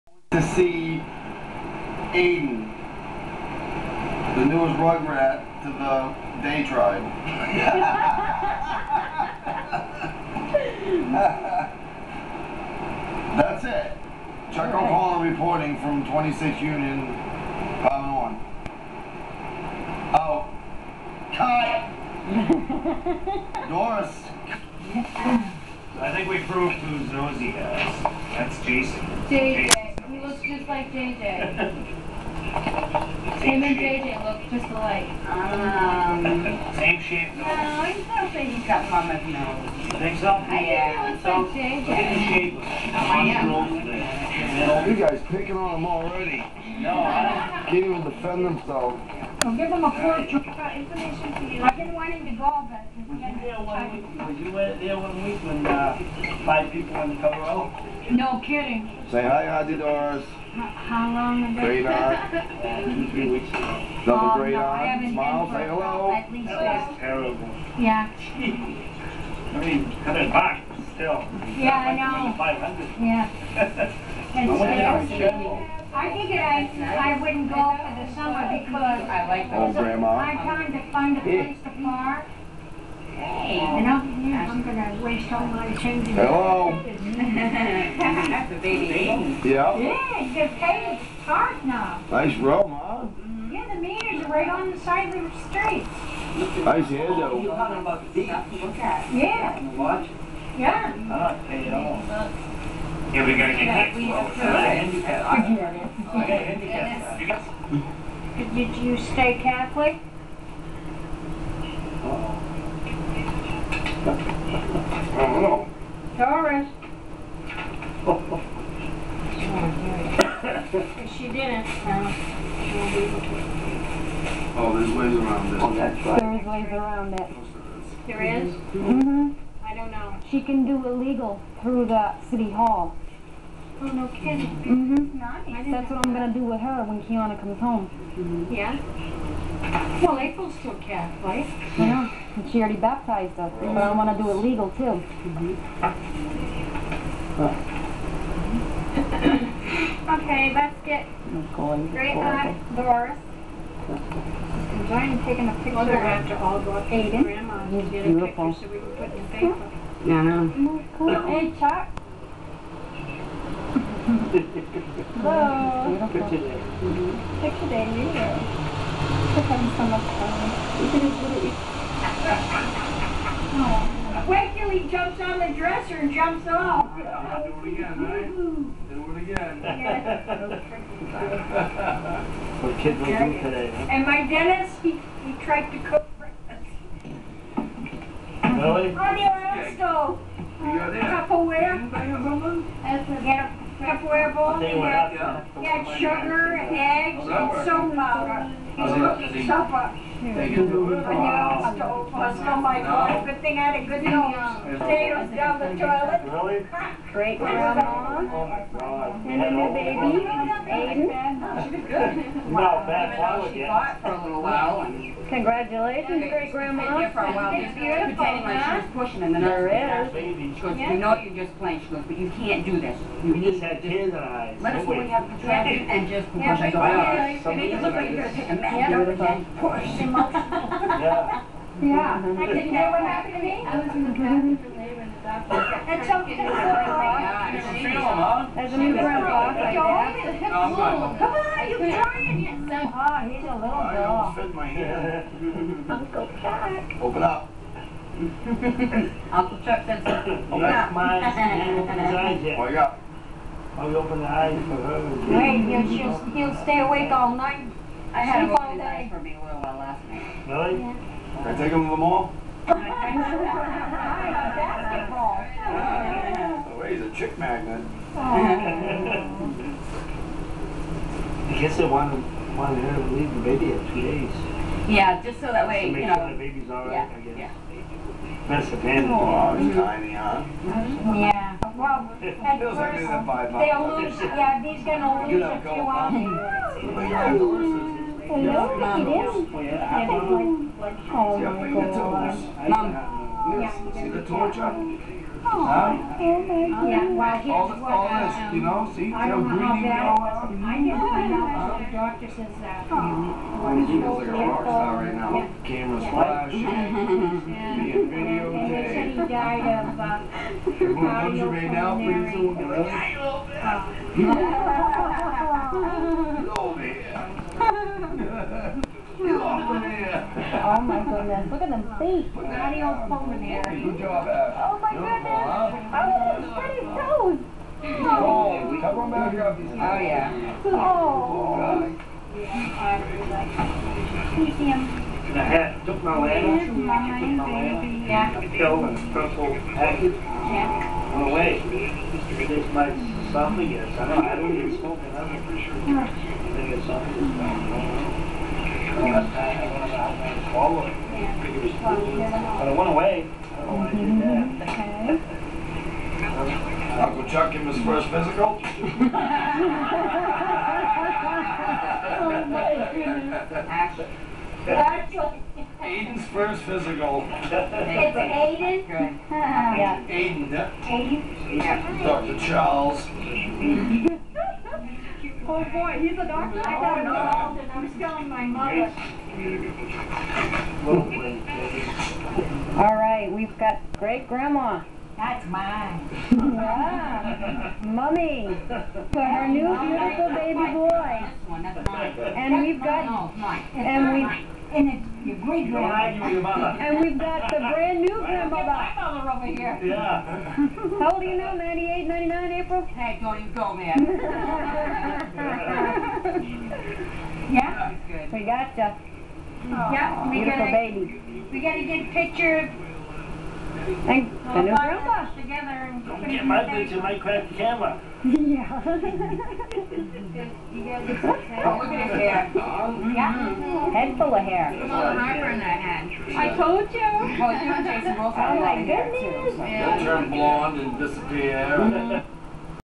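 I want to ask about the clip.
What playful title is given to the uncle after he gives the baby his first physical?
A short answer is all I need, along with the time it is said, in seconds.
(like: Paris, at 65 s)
Dr. Charles, at 372 s.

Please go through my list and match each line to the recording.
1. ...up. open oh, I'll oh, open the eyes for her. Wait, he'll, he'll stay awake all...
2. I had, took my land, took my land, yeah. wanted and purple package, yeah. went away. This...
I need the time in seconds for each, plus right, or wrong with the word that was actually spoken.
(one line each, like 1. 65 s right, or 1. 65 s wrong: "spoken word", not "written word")
1. 250 s right
2. 335 s wrong: "killed", not "wanted".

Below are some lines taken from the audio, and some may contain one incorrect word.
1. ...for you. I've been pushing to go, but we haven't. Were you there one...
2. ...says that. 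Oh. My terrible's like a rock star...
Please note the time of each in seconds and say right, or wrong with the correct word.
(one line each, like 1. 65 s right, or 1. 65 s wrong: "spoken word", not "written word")
1. 51 s wrong: "wanting", not "pushing"
2. 302 s wrong: "eagle", not "terrible".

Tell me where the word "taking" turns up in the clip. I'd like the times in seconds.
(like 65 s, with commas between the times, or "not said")
154 s.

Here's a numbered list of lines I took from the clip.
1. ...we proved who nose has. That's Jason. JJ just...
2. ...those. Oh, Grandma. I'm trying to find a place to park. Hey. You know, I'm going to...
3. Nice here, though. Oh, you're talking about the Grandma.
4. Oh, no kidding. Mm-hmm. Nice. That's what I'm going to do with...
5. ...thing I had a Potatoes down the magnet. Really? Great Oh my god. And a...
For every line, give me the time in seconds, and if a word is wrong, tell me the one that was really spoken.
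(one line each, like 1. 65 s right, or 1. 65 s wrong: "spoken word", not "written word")
1. 26 s right
2. 79 s right
3. 96 s wrong: "Yeah", not "Grandma"
4. 133 s right
5. 203 s wrong: "toilet", not "magnet".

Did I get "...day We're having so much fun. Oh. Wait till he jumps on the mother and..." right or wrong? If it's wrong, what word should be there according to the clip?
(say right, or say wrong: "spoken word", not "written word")
wrong: "dresser", not "mother".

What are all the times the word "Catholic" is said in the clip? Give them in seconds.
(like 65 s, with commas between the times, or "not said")
109 s, 140 s.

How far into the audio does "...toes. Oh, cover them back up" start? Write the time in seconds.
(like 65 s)
326 s.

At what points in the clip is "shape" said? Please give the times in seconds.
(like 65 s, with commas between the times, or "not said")
37 s, 42 s.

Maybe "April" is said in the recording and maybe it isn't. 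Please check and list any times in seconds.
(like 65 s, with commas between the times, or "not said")
140 s, 402 s.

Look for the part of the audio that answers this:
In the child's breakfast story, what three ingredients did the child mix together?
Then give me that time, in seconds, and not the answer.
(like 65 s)
195 s.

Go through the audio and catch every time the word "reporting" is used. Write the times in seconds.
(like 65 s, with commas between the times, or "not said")
15 s.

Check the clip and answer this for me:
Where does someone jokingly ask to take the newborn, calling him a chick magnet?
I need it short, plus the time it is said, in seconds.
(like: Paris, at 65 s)
The mall, at 261 s.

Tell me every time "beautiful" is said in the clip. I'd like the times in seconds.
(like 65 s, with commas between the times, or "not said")
157 s, 217 s, 389 s, 410 s.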